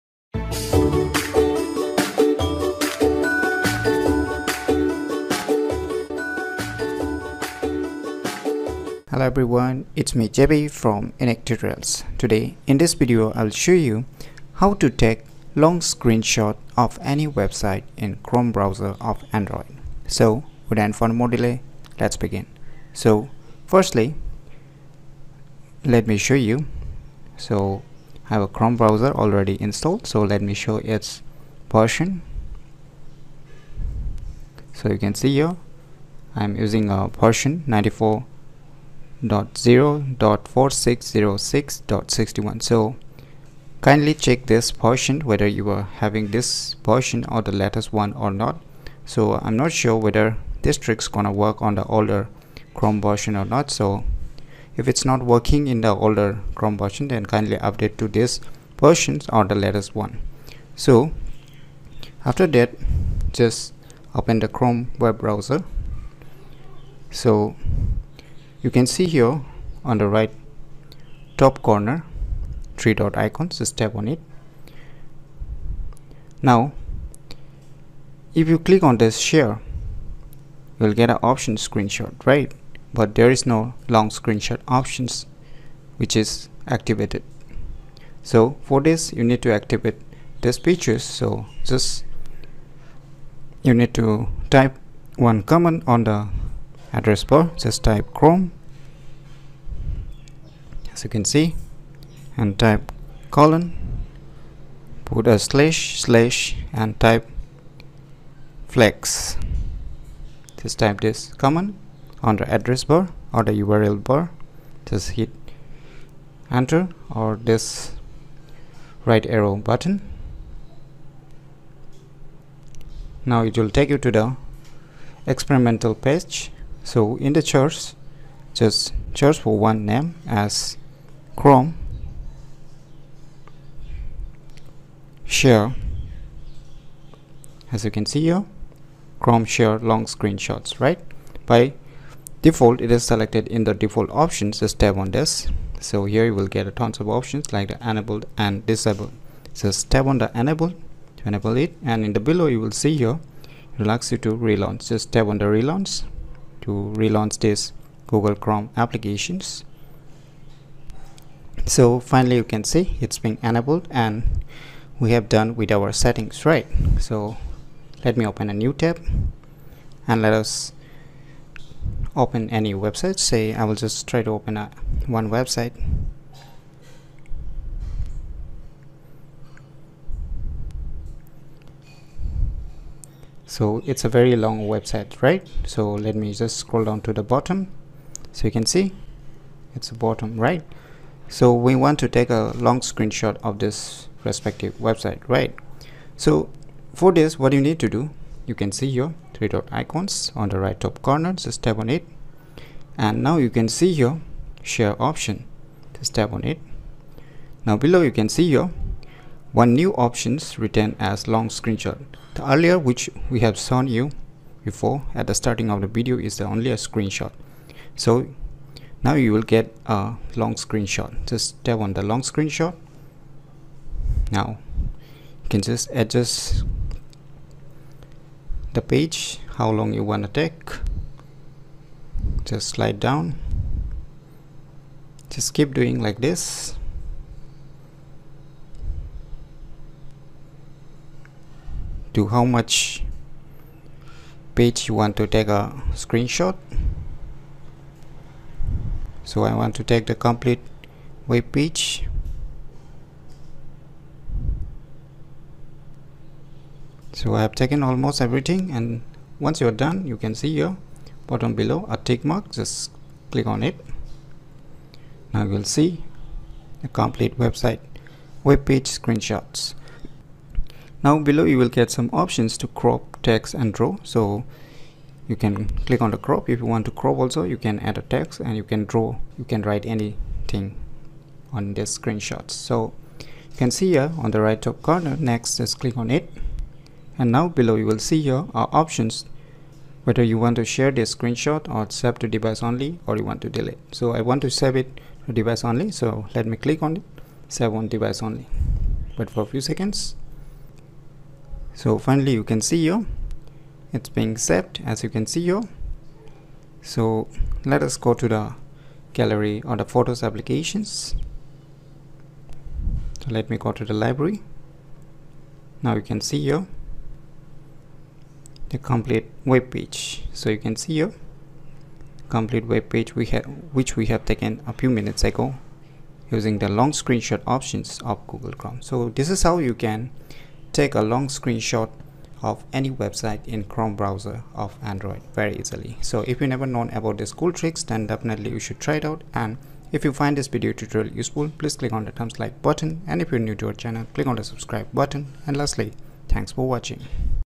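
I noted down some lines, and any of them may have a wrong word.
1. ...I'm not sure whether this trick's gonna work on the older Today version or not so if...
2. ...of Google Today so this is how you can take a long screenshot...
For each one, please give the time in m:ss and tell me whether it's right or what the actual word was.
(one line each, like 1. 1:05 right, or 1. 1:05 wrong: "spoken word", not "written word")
1. 0:49 wrong: "Chrome", not "Today"
2. 5:28 wrong: "Chrome", not "Today".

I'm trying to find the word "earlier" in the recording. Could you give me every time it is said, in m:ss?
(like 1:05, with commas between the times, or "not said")
3:32.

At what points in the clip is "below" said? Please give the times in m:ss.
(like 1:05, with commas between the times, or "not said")
2:32, 3:27, 4:21, 4:31, 4:47.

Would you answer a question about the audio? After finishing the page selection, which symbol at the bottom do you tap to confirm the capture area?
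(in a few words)
tick mark.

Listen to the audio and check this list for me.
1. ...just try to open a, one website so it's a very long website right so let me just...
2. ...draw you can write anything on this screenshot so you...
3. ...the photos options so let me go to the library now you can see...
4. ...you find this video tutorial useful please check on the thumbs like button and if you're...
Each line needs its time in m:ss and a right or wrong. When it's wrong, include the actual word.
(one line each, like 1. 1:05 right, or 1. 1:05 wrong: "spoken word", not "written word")
1. 2:53 right
2. 4:38 right
3. 5:09 wrong: "applications", not "options"
4. 5:40 wrong: "click", not "check".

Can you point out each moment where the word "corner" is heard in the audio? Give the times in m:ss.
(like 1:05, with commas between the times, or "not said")
1:11, 3:21, 4:44.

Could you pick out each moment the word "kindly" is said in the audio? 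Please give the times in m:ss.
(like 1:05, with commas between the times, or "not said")
0:43, 0:57.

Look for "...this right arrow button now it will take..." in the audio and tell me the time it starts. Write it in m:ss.
1:57.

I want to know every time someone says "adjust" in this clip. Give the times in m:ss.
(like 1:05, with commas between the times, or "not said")
3:45.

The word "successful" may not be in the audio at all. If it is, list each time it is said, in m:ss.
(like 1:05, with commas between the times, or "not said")
not said.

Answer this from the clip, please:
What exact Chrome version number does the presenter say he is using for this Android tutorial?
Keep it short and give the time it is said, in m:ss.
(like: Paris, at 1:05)
94.0.4606.61, at 0:37.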